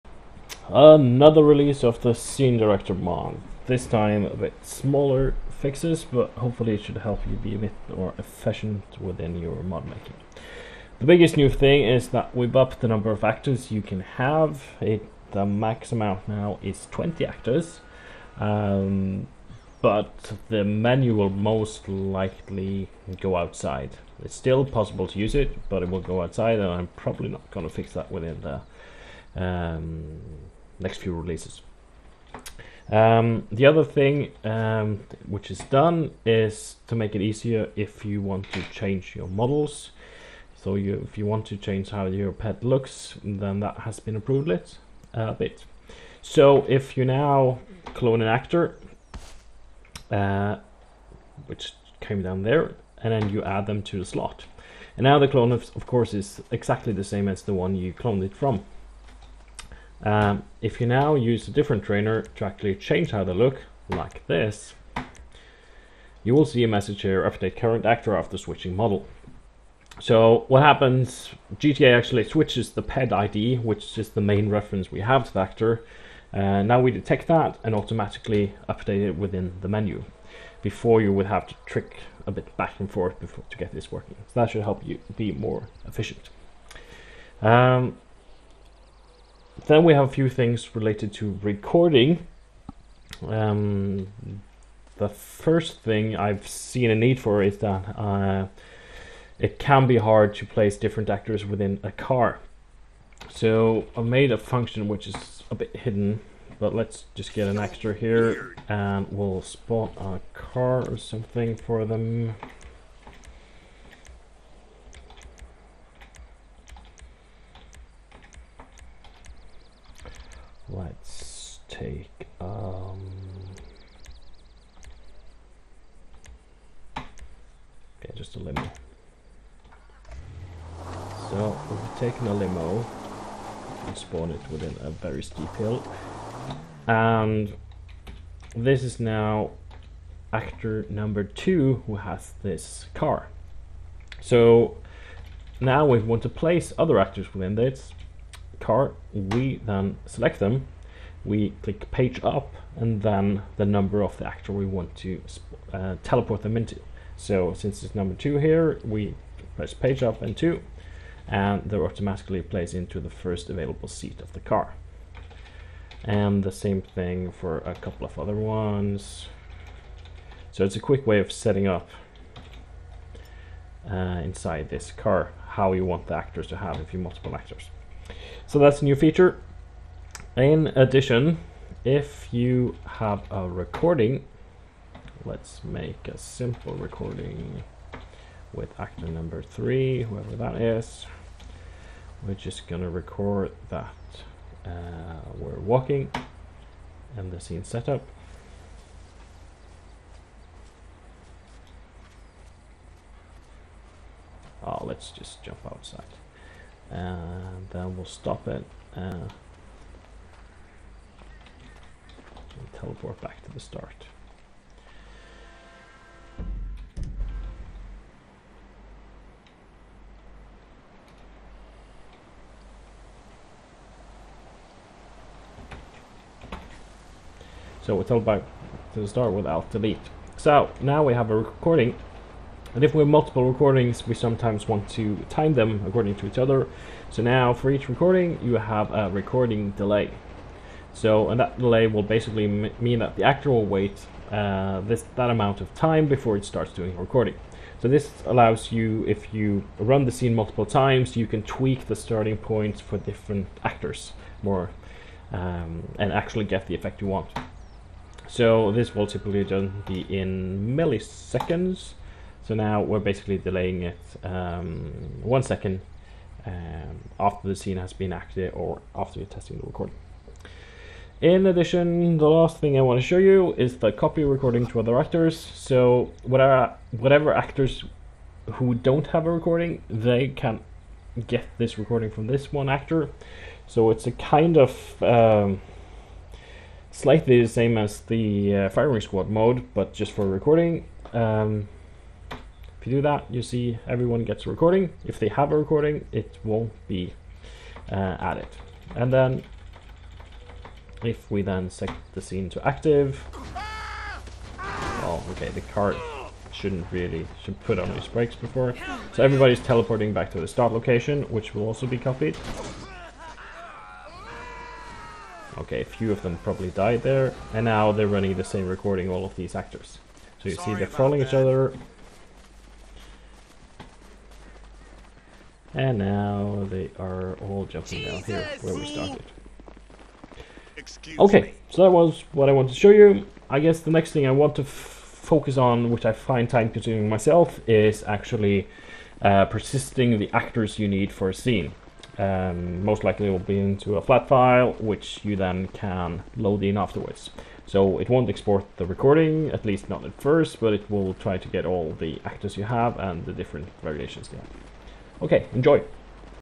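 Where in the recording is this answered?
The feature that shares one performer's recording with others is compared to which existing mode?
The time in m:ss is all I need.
4:48.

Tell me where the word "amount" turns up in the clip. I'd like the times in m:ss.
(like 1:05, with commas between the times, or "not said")
0:15, 4:05.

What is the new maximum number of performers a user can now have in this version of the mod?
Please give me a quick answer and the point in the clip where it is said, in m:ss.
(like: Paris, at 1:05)
20, at 0:16.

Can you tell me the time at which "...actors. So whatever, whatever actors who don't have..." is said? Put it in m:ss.
4:34.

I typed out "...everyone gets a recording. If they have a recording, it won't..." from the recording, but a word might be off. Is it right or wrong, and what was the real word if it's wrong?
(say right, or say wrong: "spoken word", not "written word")
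right.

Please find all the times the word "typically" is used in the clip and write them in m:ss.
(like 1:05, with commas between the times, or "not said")
4:19.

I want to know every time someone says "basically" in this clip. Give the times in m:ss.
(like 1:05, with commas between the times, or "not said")
4:02, 4:22.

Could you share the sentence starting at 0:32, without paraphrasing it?
Um, the other thing um, which is done is to make it easier if you want to change your models.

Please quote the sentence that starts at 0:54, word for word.
And now the clone, of, of course, is exactly the same as the one you cloned it from.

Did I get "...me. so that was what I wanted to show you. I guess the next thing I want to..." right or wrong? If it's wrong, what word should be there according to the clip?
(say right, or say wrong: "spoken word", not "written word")
right.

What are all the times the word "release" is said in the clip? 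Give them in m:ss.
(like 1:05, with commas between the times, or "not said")
0:01, 0:31.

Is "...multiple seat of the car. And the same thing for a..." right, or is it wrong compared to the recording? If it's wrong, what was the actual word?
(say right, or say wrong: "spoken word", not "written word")
wrong: "available", not "multiple".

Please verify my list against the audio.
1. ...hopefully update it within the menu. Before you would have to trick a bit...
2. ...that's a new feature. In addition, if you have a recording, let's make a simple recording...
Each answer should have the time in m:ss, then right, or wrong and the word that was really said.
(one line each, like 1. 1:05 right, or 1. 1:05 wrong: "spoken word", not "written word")
1. 1:17 wrong: "automatically", not "hopefully"
2. 2:58 right.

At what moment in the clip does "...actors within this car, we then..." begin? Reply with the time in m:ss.
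2:26.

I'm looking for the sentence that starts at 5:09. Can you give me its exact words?
So everybody's teleporting back to the start location, which will also be copied.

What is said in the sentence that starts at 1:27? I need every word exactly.
Um, then we have a few things related to recording.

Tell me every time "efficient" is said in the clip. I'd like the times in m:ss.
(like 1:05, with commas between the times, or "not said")
0:08, 1:25.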